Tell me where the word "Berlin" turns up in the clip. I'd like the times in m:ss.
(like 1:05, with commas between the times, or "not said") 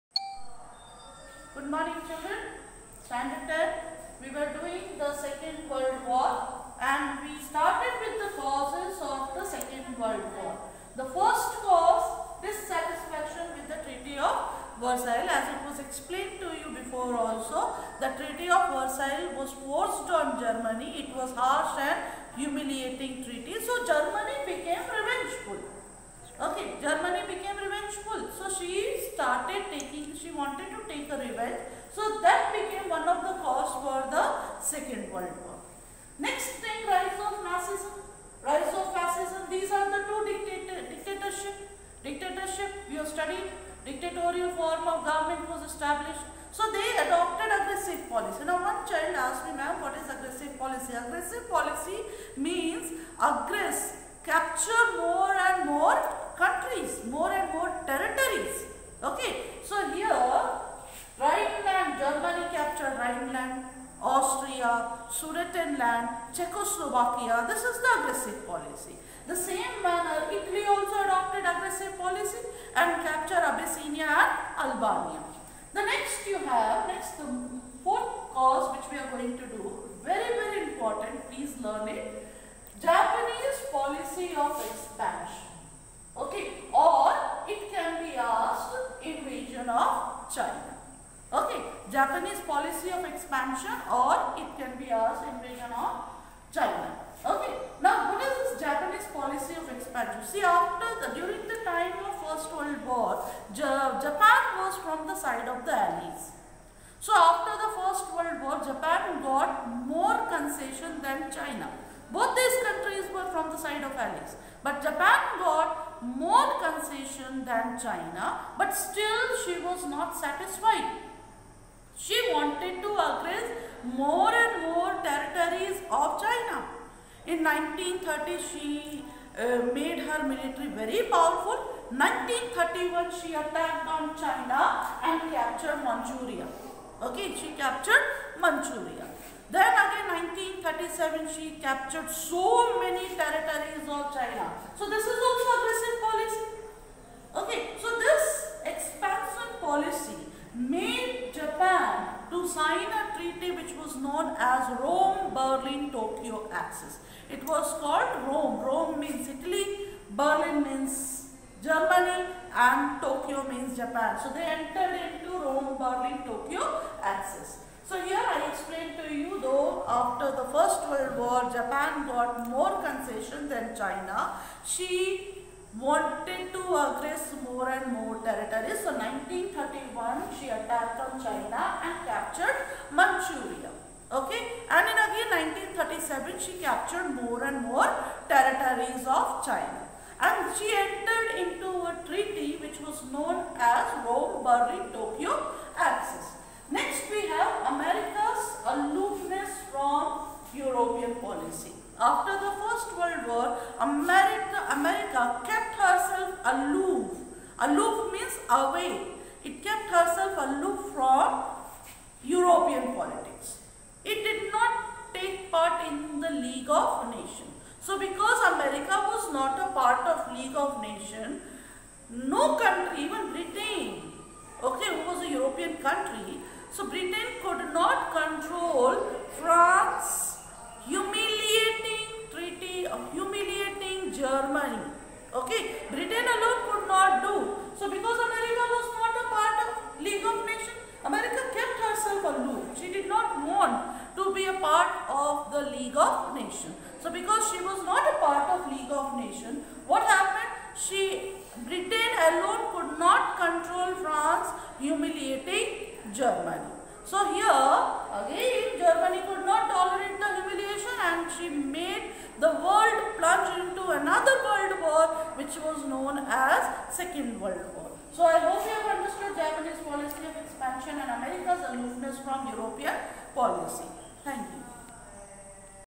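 2:35, 2:40, 2:45, 3:14.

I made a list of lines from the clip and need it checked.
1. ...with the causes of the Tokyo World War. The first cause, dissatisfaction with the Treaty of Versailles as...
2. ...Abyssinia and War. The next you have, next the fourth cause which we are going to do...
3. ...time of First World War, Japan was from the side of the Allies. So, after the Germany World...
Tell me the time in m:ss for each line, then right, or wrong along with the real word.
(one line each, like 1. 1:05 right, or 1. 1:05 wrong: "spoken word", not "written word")
1. 0:08 wrong: "Second", not "Tokyo"
2. 1:13 wrong: "Albania", not "War"
3. 1:41 wrong: "First", not "Germany".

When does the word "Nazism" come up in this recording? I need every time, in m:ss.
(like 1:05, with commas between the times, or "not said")
0:37.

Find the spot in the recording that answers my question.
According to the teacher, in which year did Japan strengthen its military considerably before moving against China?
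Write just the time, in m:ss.
2:07.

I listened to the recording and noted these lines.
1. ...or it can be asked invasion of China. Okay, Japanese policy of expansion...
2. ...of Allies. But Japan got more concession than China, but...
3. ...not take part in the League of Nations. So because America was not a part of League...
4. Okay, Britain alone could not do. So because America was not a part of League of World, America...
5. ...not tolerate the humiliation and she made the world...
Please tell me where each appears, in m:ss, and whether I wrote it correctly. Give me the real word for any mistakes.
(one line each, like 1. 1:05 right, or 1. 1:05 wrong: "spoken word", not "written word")
1. 1:26 right
2. 1:53 right
3. 3:34 right
4. 3:55 wrong: "Nations", not "World"
5. 4:19 right.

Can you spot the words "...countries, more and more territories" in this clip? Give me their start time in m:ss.
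0:56.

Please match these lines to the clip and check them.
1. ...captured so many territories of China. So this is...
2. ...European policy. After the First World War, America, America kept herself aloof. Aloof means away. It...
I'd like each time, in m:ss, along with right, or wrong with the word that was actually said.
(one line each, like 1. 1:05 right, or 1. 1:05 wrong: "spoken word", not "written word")
1. 2:21 right
2. 3:20 right.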